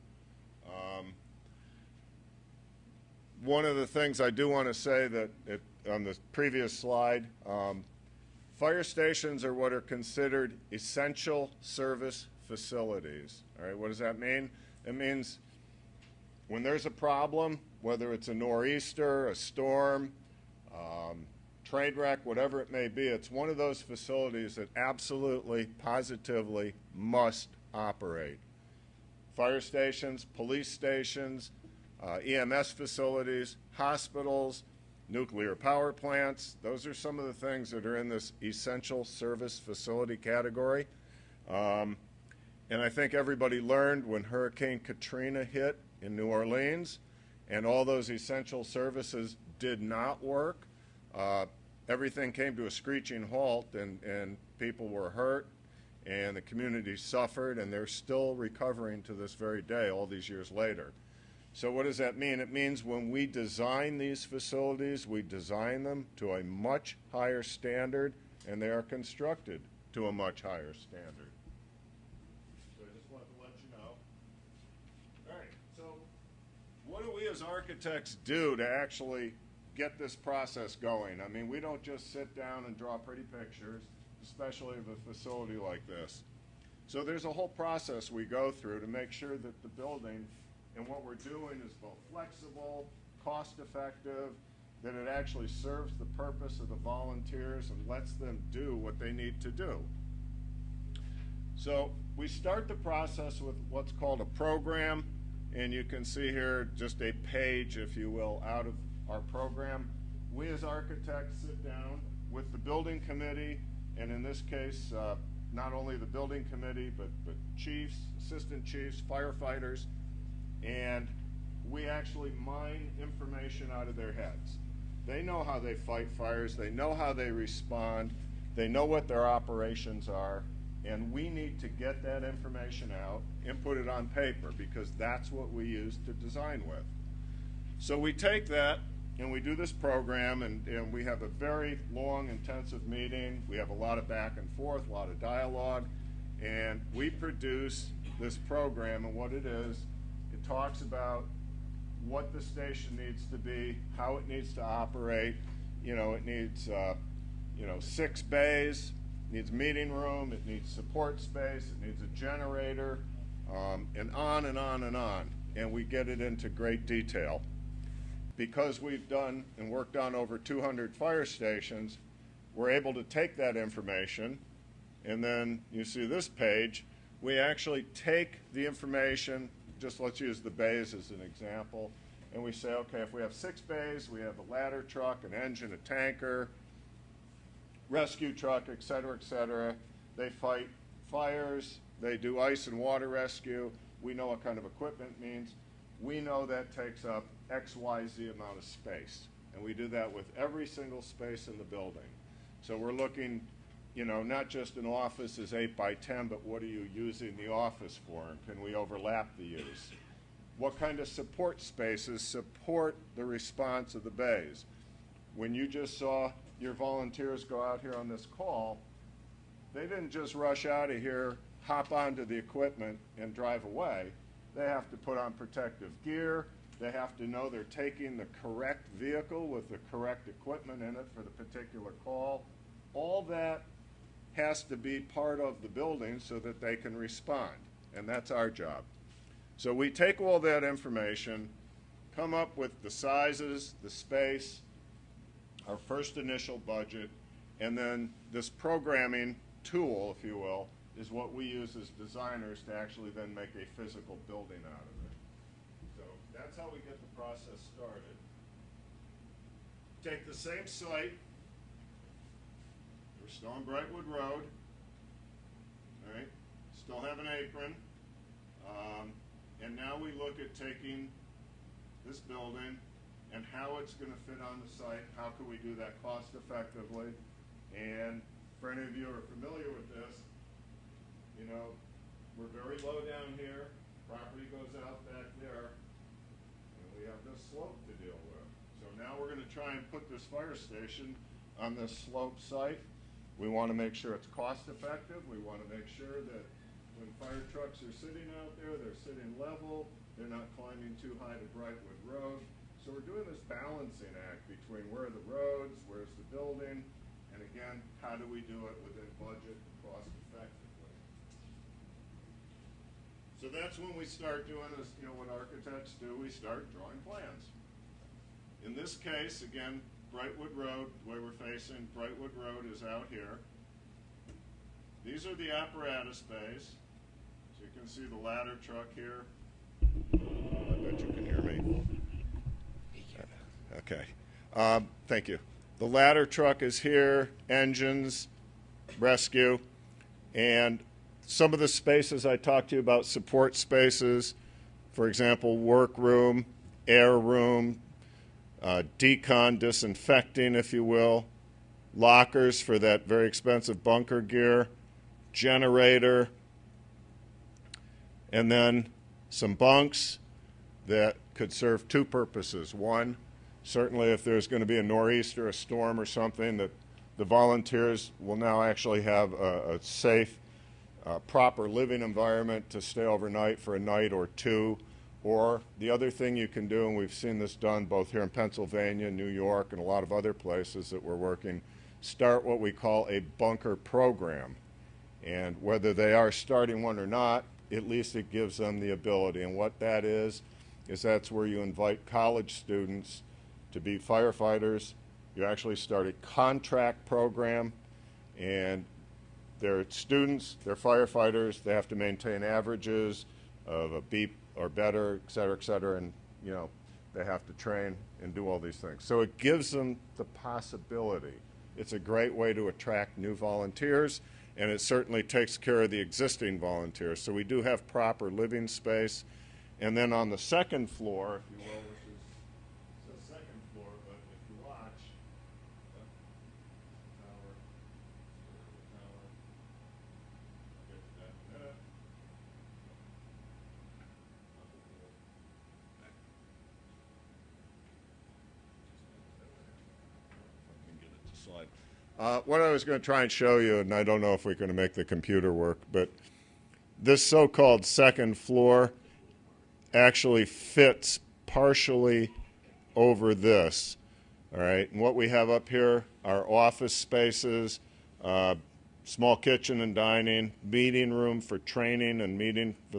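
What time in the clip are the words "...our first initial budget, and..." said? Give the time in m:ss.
4:05.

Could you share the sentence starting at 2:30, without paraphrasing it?
It talks about what the station needs to be, how it needs to operate.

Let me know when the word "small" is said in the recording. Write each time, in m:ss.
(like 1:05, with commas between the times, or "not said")
7:39.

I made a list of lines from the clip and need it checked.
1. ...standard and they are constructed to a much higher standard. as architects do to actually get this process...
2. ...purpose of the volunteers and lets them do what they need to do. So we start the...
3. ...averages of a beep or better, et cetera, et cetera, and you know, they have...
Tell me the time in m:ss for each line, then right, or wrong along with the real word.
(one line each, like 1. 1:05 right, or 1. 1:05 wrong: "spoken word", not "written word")
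1. 1:07 right
2. 1:36 right
3. 6:42 right.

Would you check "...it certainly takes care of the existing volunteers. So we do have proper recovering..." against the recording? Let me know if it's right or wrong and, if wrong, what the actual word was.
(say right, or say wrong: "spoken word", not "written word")
wrong: "living", not "recovering".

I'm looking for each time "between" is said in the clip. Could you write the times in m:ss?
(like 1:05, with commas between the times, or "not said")
5:04.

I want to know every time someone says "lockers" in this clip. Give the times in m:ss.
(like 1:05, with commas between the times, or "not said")
5:51.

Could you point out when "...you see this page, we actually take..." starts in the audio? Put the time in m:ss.
2:55.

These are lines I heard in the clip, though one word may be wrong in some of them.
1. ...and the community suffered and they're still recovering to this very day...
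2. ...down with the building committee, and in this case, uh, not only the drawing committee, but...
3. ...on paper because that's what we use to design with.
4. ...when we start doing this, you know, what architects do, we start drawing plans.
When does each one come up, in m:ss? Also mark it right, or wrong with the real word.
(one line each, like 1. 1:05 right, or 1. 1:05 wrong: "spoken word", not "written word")
1. 0:56 right
2. 1:51 wrong: "building", not "drawing"
3. 2:13 right
4. 5:13 right.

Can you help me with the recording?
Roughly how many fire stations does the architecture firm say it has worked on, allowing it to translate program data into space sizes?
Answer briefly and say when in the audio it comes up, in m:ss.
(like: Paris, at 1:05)
over 200, at 2:50.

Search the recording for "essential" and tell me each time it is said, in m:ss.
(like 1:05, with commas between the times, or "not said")
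0:10, 0:38, 0:48.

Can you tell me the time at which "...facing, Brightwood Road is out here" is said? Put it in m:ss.
5:21.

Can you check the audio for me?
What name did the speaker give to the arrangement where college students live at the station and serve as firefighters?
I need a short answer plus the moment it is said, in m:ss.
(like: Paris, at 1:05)
bunker program, at 6:23.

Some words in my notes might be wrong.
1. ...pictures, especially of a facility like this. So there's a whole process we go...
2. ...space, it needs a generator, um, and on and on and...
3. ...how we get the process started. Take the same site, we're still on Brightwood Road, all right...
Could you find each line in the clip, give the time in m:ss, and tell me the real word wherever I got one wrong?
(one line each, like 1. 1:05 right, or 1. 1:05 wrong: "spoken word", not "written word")
1. 1:23 right
2. 2:41 right
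3. 4:16 right.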